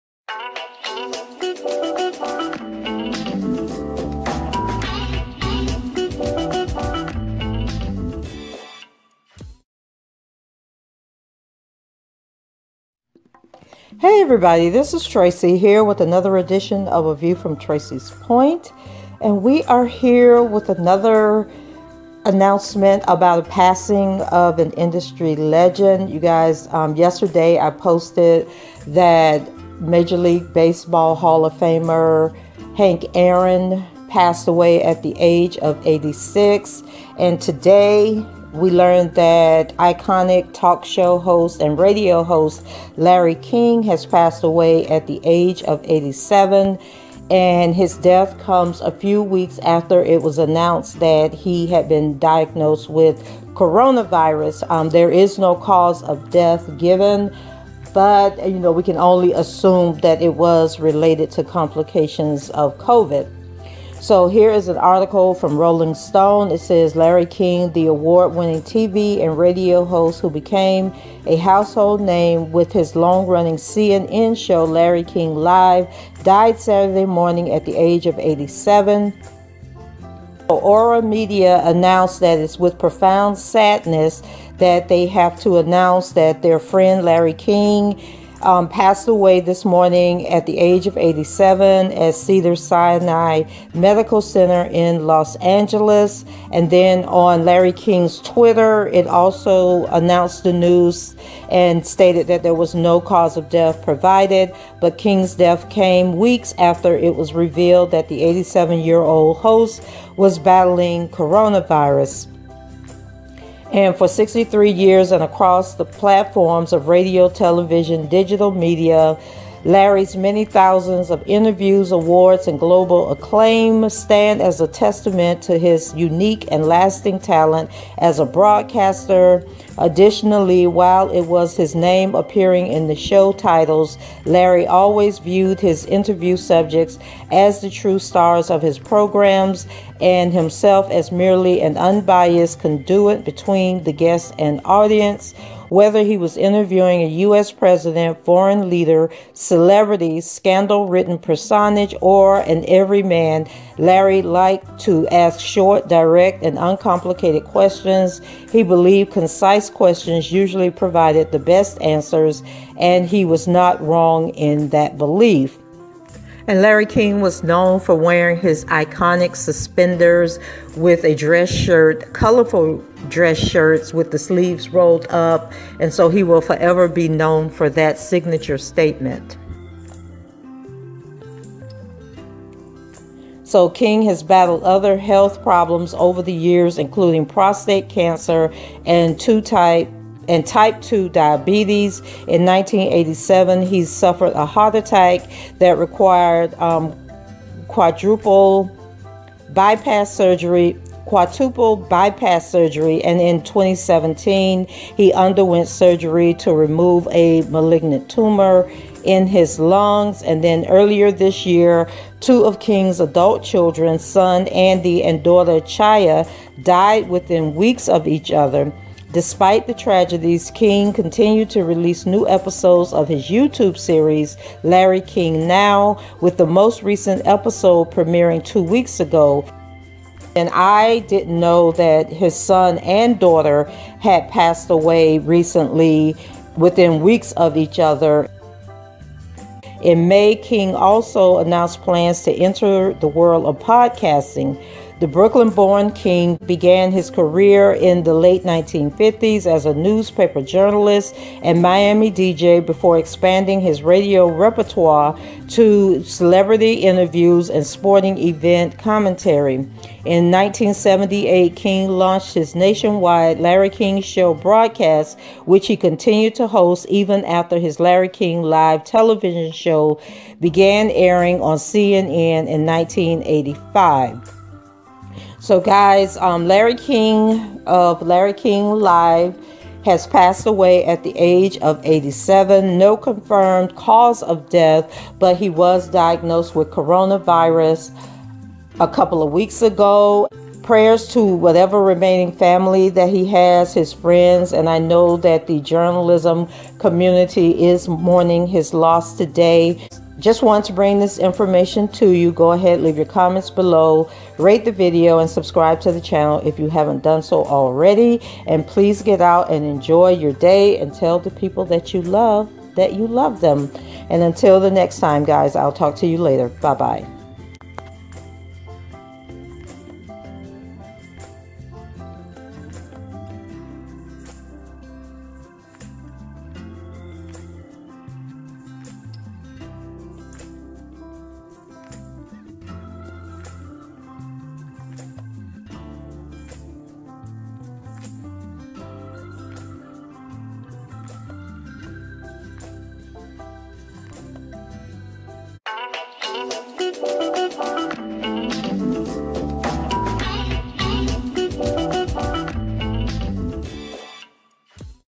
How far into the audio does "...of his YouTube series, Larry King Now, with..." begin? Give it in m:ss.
3:42.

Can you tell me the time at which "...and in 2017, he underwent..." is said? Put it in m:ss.
3:23.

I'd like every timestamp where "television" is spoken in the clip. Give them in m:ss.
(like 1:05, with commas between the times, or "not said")
1:57, 4:28.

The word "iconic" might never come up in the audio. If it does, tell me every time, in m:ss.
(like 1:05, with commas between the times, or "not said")
0:39, 2:48.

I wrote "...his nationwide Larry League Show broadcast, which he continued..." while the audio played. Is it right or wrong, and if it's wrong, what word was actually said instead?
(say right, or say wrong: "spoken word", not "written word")
wrong: "King", not "League".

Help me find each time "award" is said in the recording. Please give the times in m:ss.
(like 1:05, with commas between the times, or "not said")
1:07, 2:01.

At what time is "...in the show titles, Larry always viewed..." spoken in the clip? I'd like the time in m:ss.
2:12.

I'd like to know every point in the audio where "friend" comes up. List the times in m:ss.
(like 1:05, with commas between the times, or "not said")
1:26, 4:53.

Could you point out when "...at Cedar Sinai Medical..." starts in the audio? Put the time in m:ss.
1:31.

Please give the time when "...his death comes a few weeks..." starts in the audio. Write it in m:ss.
0:47.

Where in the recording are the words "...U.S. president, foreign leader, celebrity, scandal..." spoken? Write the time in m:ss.
2:27.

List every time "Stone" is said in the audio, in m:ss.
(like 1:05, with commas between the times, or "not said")
1:05.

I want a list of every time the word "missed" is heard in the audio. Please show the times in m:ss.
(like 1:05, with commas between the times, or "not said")
not said.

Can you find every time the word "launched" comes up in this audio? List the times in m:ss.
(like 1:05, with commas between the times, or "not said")
4:21.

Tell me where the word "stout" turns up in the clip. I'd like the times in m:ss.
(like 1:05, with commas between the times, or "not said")
not said.